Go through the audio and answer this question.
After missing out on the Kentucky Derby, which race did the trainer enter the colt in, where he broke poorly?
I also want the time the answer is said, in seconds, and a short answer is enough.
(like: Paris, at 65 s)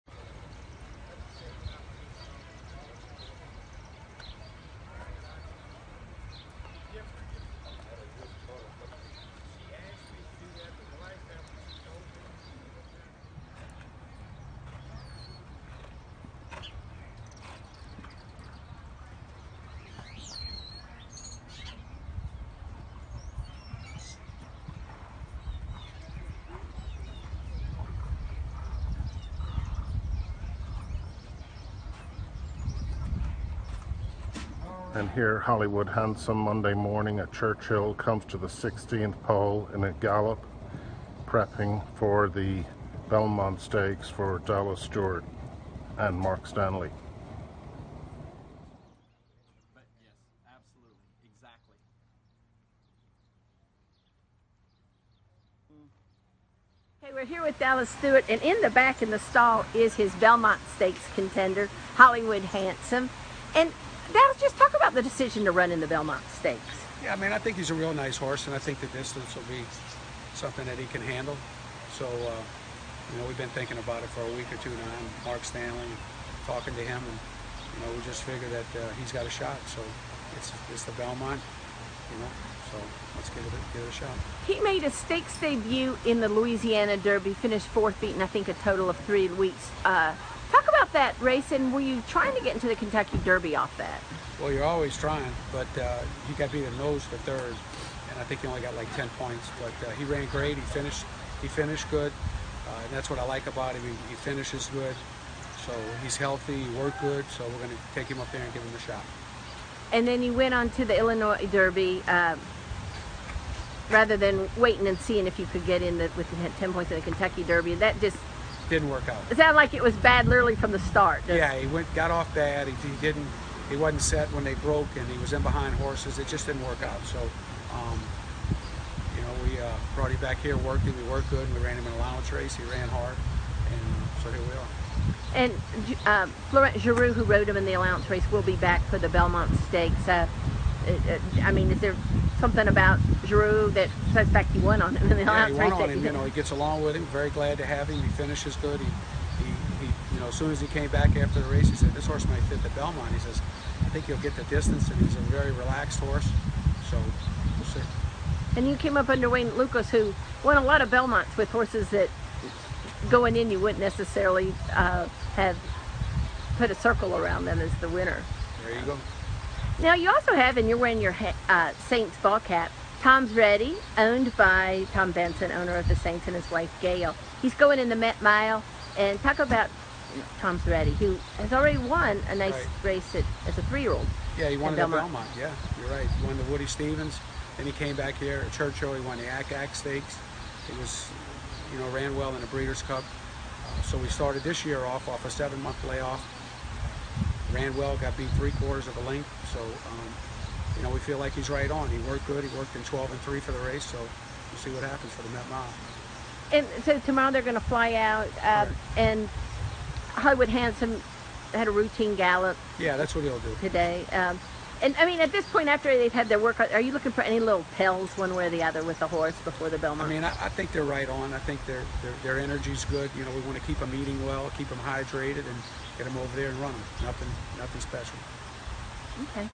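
Illinois Derby, at 110 s.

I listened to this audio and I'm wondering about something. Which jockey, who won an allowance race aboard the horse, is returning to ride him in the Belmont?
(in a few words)
Florent Geroux.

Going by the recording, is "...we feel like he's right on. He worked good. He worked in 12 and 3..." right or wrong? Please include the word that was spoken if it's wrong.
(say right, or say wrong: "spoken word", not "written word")
right.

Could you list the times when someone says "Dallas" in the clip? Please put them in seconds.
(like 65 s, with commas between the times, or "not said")
44 s, 57 s, 64 s.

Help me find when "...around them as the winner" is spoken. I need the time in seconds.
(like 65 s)
167 s.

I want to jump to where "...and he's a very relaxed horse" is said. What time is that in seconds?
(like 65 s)
154 s.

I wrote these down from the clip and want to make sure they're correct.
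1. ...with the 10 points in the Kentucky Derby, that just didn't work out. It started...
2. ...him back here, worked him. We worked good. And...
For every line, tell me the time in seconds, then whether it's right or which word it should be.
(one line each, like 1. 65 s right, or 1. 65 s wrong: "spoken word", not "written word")
1. 116 s wrong: "sounded", not "started"
2. 130 s right.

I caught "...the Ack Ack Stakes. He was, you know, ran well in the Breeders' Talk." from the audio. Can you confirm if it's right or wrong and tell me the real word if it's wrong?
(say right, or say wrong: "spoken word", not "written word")
wrong: "Cup", not "Talk".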